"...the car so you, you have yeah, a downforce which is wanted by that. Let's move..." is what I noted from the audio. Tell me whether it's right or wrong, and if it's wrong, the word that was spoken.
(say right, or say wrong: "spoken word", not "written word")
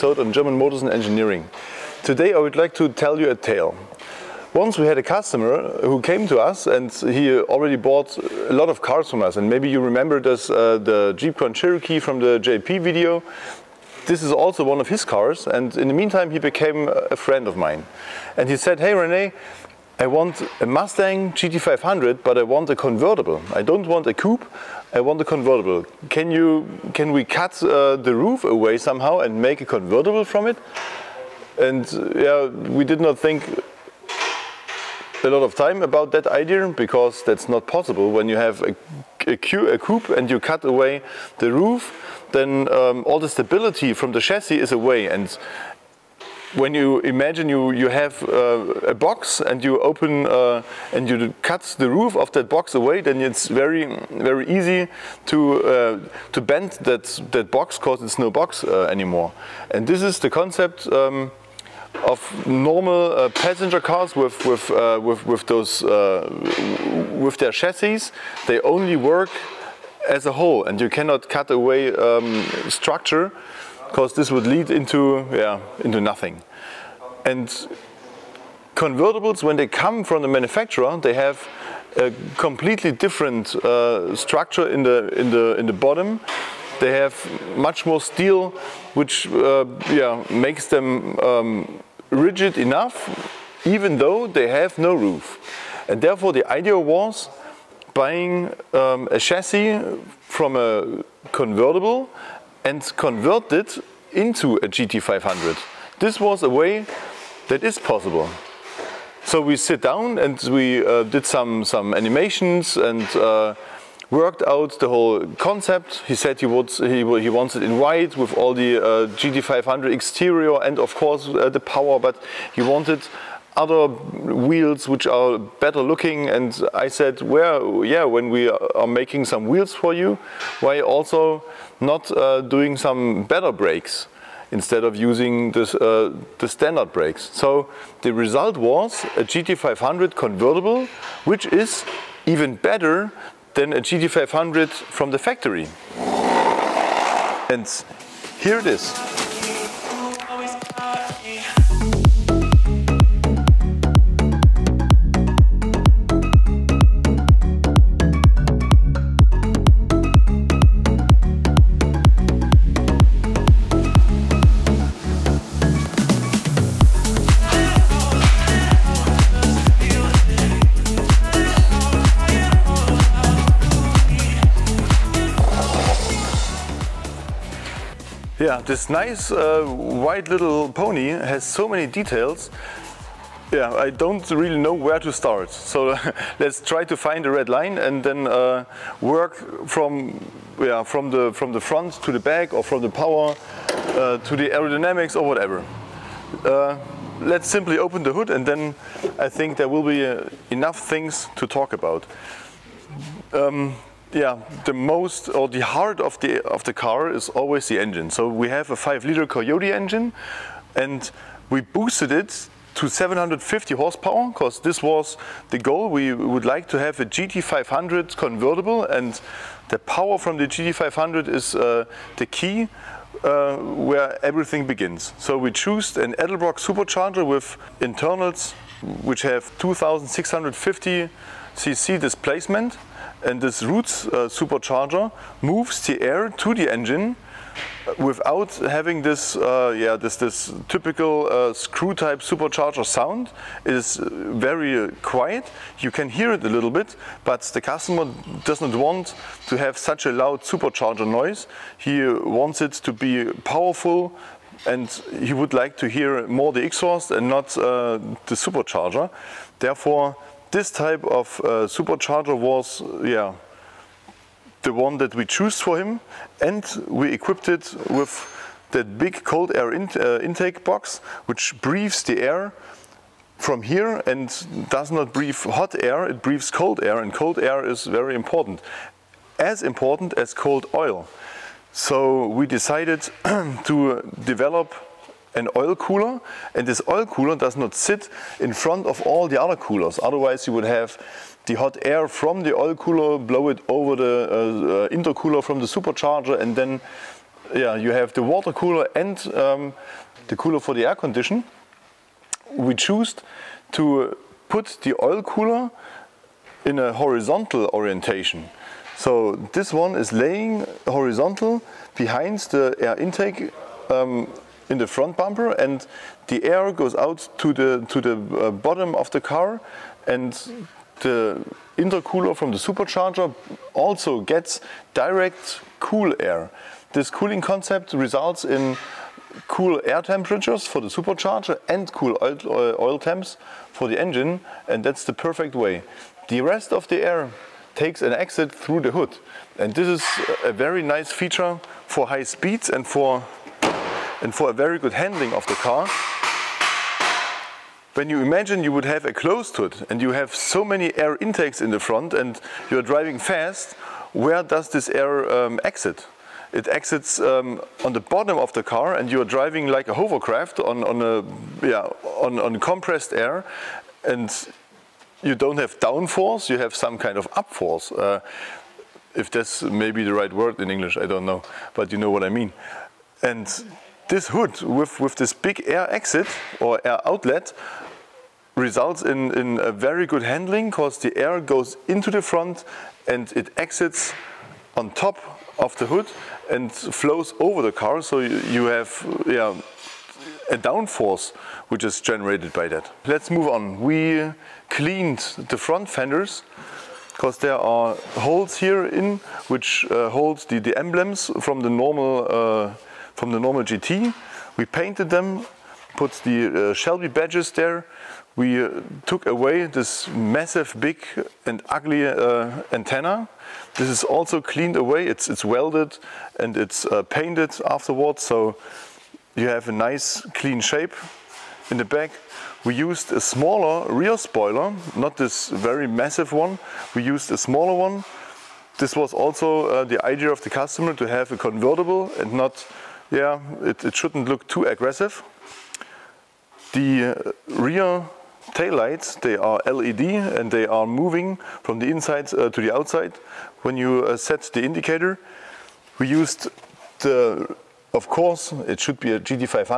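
wrong: "generated", not "wanted".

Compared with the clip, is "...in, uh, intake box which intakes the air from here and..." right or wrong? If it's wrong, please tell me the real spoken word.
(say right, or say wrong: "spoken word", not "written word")
wrong: "breathes", not "intakes".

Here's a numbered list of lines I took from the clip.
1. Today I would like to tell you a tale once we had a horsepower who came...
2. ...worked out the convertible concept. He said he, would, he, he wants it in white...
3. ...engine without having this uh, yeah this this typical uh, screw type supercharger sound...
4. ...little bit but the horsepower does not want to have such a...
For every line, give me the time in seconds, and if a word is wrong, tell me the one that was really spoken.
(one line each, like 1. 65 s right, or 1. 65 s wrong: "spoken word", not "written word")
1. 2 s wrong: "customer", not "horsepower"
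2. 114 s wrong: "whole", not "convertible"
3. 236 s right
4. 246 s wrong: "customer", not "horsepower".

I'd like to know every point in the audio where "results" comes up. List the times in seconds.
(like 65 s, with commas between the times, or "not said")
138 s, 327 s, 378 s.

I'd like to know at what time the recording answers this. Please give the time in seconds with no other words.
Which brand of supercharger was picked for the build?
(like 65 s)
226 s.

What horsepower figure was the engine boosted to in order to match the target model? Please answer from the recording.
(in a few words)
750.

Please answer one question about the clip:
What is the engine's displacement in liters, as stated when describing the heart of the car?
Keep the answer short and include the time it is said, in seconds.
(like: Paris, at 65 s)
5 liters, at 208 s.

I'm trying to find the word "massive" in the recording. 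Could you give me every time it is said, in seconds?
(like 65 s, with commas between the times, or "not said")
410 s, 425 s.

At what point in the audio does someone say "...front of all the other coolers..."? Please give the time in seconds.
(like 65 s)
288 s.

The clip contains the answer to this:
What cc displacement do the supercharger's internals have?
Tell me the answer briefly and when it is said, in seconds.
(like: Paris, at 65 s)
2650 cc, at 229 s.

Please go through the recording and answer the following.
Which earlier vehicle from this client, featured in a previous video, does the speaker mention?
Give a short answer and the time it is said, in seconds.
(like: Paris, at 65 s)
Jeep Grand Cherokee, at 11 s.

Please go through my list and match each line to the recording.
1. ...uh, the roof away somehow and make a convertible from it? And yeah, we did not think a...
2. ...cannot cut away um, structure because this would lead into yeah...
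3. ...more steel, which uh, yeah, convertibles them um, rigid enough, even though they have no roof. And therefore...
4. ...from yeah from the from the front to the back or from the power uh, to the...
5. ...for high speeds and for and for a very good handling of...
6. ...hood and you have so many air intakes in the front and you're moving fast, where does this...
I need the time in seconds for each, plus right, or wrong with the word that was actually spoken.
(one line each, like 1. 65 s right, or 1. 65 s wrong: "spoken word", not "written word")
1. 27 s right
2. 70 s right
3. 87 s wrong: "makes", not "convertibles"
4. 189 s right
5. 341 s right
6. 349 s wrong: "driving", not "moving".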